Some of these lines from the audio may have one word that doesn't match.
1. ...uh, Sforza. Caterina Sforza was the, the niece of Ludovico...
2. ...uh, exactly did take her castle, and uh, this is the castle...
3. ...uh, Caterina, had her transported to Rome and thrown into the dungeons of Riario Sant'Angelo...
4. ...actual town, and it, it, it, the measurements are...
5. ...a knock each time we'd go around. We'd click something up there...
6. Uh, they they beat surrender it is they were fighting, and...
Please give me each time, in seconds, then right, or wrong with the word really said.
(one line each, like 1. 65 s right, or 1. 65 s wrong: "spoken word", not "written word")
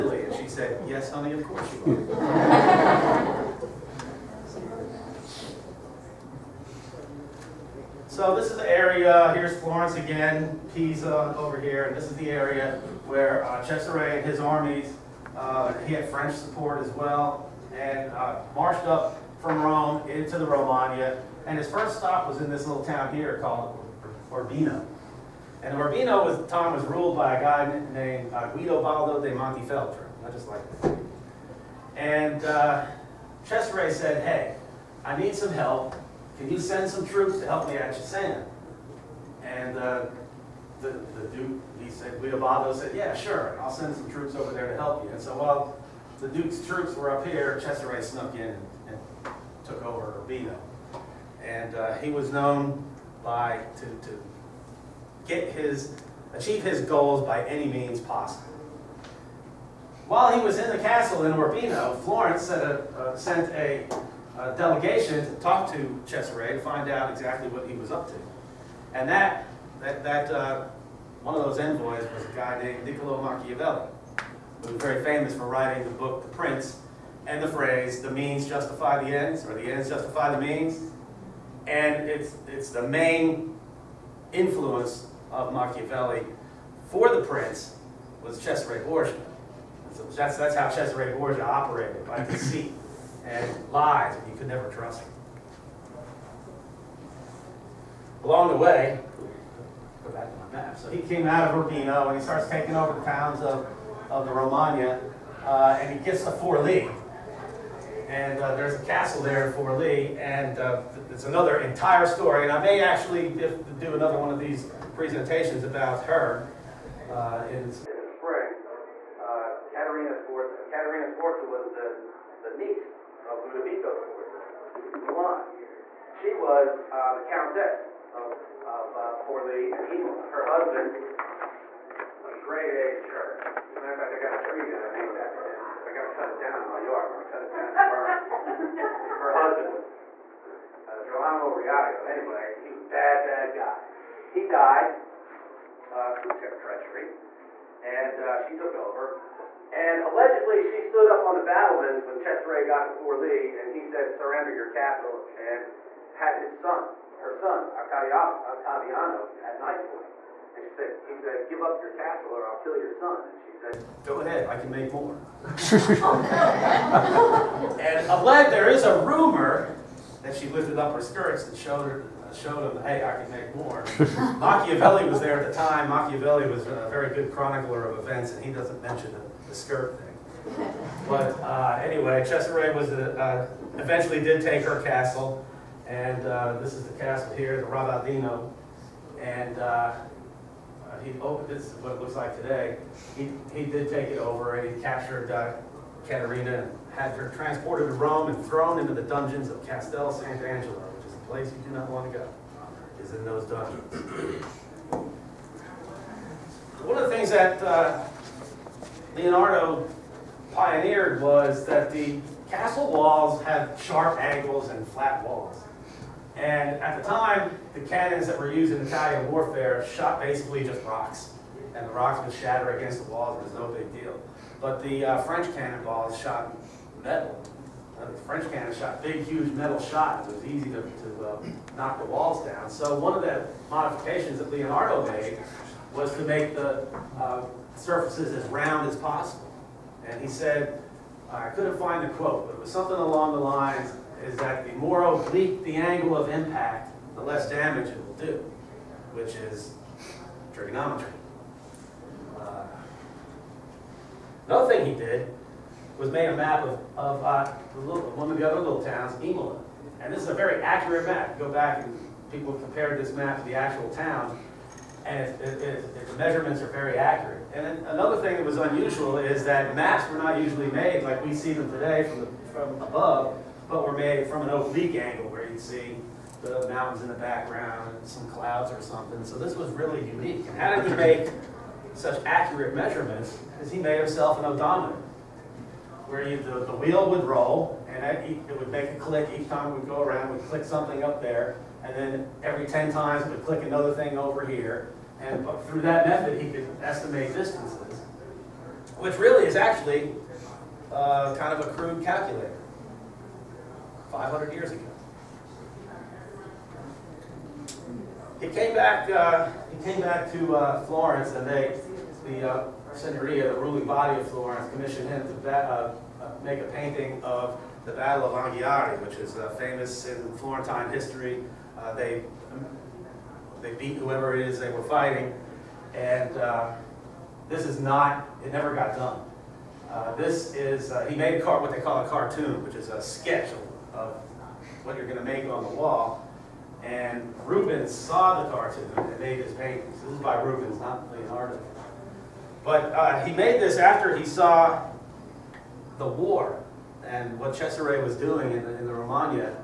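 1. 120 s right
2. 183 s wrong: "eventually", not "exactly"
3. 195 s wrong: "Castel", not "Riario"
4. 263 s right
5. 288 s wrong: "click", not "knock"
6. 321 s wrong: "whoever", not "surrender".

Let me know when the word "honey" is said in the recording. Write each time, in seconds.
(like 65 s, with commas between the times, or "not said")
1 s.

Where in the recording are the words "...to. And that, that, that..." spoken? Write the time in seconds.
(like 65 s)
68 s.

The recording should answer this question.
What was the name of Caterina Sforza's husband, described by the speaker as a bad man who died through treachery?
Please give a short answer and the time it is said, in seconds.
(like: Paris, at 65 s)
Gerolamo Riario, at 141 s.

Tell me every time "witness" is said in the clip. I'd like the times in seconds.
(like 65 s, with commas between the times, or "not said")
not said.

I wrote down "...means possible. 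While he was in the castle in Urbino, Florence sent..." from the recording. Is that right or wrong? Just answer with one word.
right.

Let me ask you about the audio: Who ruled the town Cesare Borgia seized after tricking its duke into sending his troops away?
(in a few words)
Guido Baldo de Montefeltro.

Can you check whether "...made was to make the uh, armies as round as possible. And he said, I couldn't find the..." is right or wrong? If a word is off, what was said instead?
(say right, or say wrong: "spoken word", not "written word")
wrong: "surfaces", not "armies".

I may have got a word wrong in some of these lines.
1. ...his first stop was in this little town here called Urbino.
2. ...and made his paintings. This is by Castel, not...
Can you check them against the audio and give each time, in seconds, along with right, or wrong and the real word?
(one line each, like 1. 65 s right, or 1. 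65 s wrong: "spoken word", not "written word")
1. 21 s right
2. 338 s wrong: "Rubens", not "Castel".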